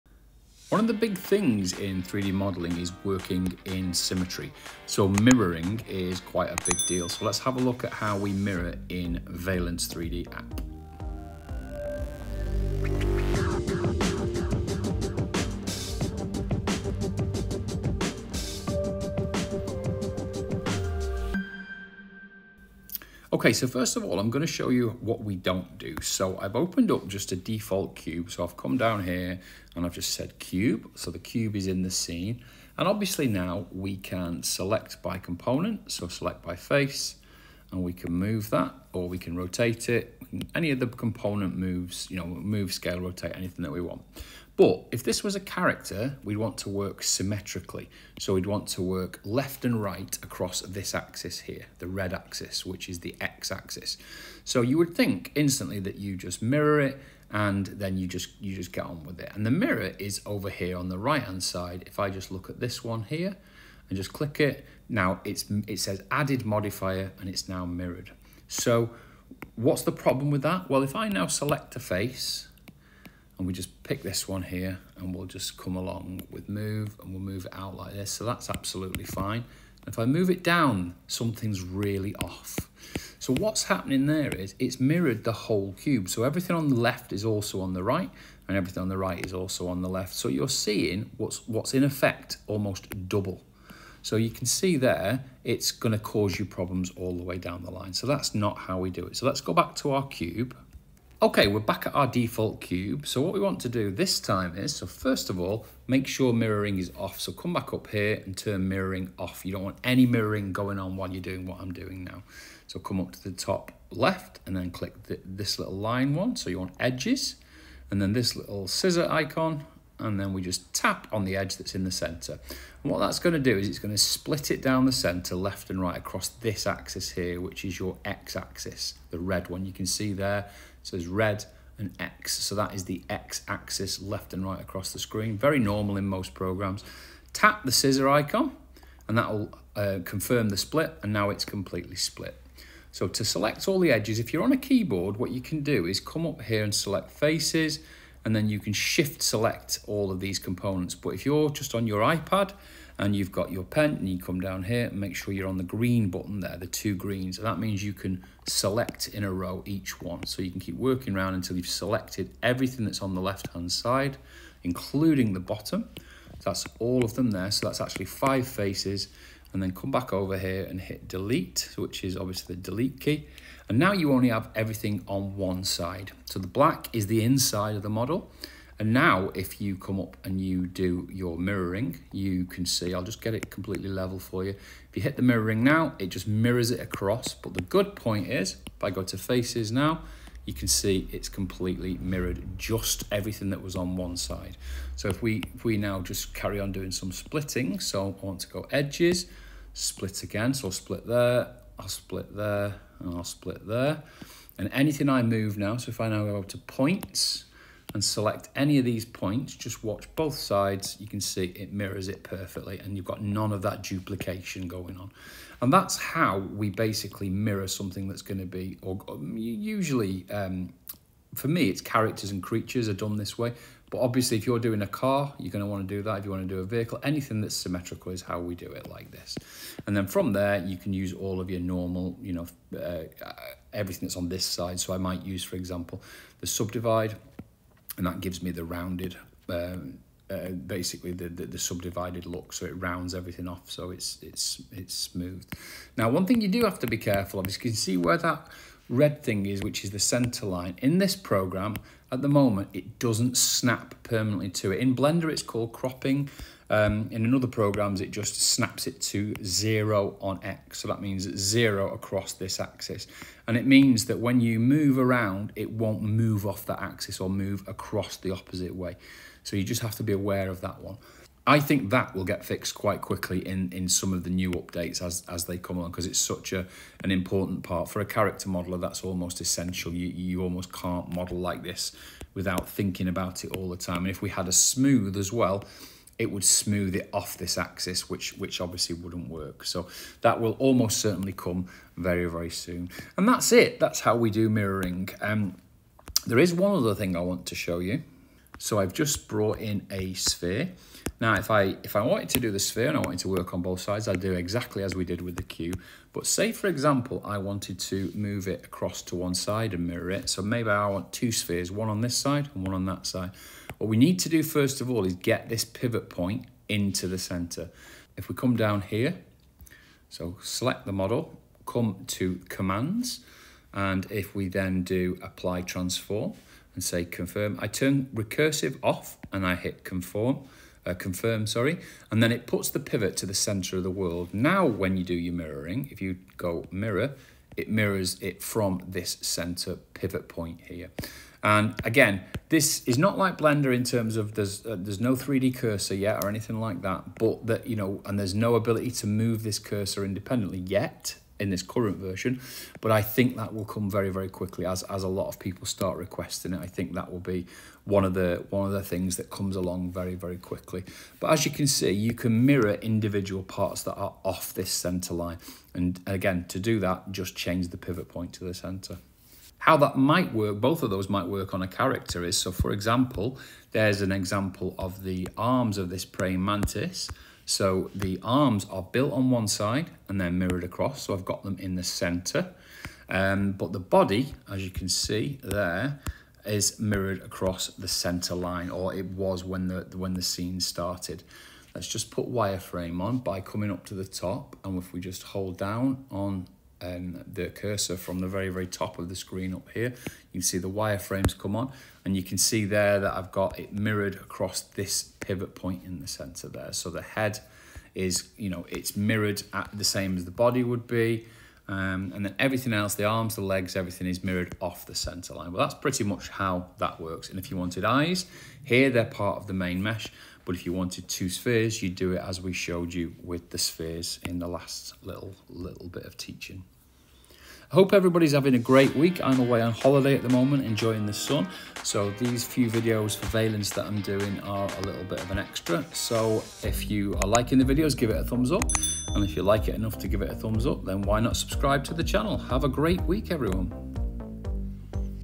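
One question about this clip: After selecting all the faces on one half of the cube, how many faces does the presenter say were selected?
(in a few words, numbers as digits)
5.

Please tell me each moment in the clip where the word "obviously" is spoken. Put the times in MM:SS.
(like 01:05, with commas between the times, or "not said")
00:32, 02:52, 03:43, 04:48.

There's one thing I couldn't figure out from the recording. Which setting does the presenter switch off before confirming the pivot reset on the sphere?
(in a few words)
recursive.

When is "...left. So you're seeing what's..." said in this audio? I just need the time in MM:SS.
01:29.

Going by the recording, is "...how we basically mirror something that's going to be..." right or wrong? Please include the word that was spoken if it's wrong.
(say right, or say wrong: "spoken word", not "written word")
right.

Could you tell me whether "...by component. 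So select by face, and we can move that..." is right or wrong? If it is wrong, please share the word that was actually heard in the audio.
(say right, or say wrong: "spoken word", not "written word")
right.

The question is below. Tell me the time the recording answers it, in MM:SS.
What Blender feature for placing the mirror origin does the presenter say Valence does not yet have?
05:45.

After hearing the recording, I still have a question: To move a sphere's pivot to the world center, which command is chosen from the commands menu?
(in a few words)
apply transform.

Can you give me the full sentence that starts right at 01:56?
So you want edges and then this little scissor icon and then we just tap on the edge that's in the center.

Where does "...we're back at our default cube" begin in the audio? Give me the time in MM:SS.
01:41.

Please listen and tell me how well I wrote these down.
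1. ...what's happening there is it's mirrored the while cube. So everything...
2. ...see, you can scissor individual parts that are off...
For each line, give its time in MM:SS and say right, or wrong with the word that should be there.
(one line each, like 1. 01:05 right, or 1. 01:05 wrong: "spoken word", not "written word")
1. 01:23 wrong: "whole", not "while"
2. 06:01 wrong: "mirror", not "scissor".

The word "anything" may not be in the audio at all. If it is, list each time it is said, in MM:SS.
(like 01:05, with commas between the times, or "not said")
00:43, 03:24, 03:47, 05:46.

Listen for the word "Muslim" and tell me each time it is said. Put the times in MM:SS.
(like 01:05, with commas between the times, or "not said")
not said.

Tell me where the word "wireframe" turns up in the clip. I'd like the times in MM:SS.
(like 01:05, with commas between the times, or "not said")
06:32, 06:40.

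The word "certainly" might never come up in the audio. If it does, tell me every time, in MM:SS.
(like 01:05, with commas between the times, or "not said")
04:50.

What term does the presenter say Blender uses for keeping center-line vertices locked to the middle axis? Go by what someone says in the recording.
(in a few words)
cropping.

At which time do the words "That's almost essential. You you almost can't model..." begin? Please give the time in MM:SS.
04:38.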